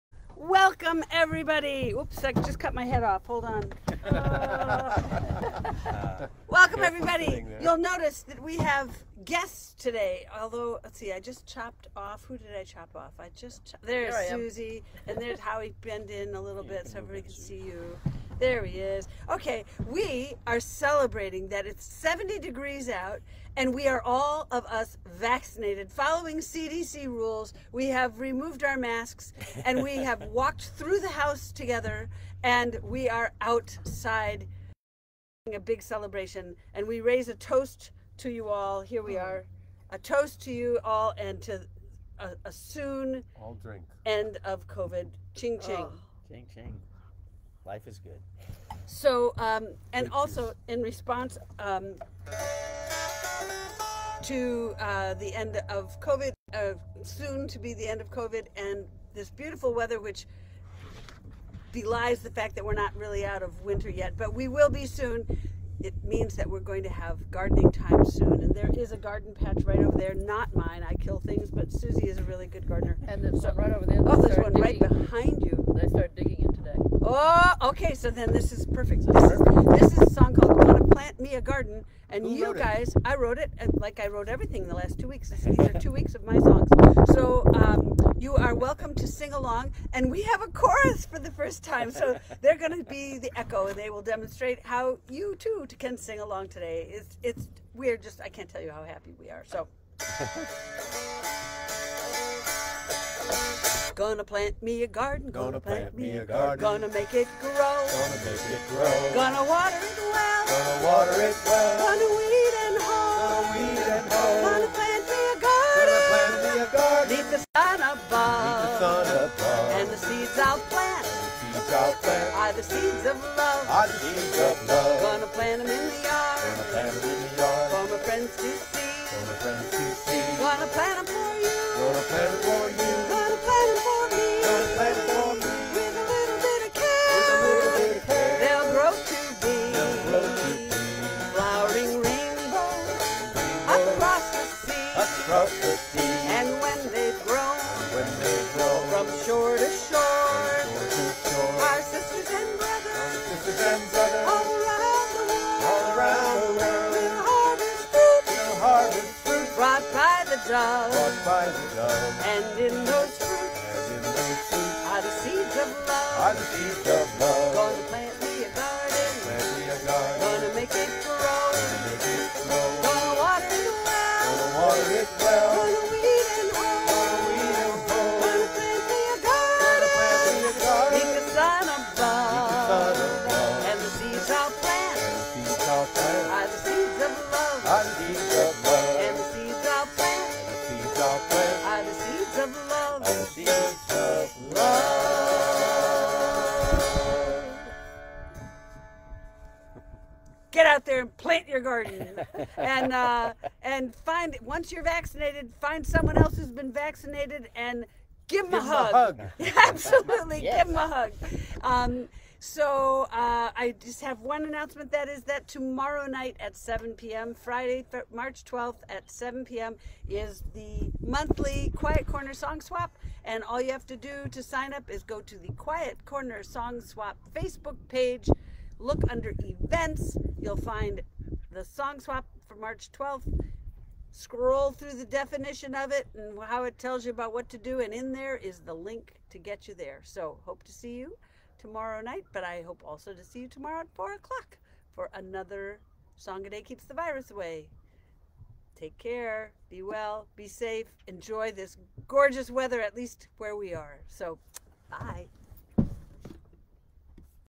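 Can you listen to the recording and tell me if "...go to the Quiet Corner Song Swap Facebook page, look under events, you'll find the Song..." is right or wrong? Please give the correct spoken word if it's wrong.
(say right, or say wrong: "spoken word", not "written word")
right.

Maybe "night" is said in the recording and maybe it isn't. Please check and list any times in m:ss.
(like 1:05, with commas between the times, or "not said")
3:36, 4:02.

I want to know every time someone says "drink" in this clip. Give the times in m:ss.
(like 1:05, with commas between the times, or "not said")
0:43.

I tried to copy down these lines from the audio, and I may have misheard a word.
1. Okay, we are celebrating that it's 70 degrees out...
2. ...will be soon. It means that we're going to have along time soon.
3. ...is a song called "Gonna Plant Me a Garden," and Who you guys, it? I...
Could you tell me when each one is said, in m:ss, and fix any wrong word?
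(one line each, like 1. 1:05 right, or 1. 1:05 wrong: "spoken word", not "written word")
1. 0:19 right
2. 1:04 wrong: "gardening", not "along"
3. 1:19 right.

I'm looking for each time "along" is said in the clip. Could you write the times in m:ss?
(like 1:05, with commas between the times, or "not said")
1:29, 1:36.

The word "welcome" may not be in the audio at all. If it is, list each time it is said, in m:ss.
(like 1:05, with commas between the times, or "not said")
0:00, 0:06, 1:28.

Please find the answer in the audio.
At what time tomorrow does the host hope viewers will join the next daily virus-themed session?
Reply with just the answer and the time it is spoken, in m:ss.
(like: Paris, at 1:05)
4 o'clock, at 4:03.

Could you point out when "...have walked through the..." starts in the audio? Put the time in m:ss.
0:29.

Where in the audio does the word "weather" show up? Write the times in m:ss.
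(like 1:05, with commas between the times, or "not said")
0:59, 4:12.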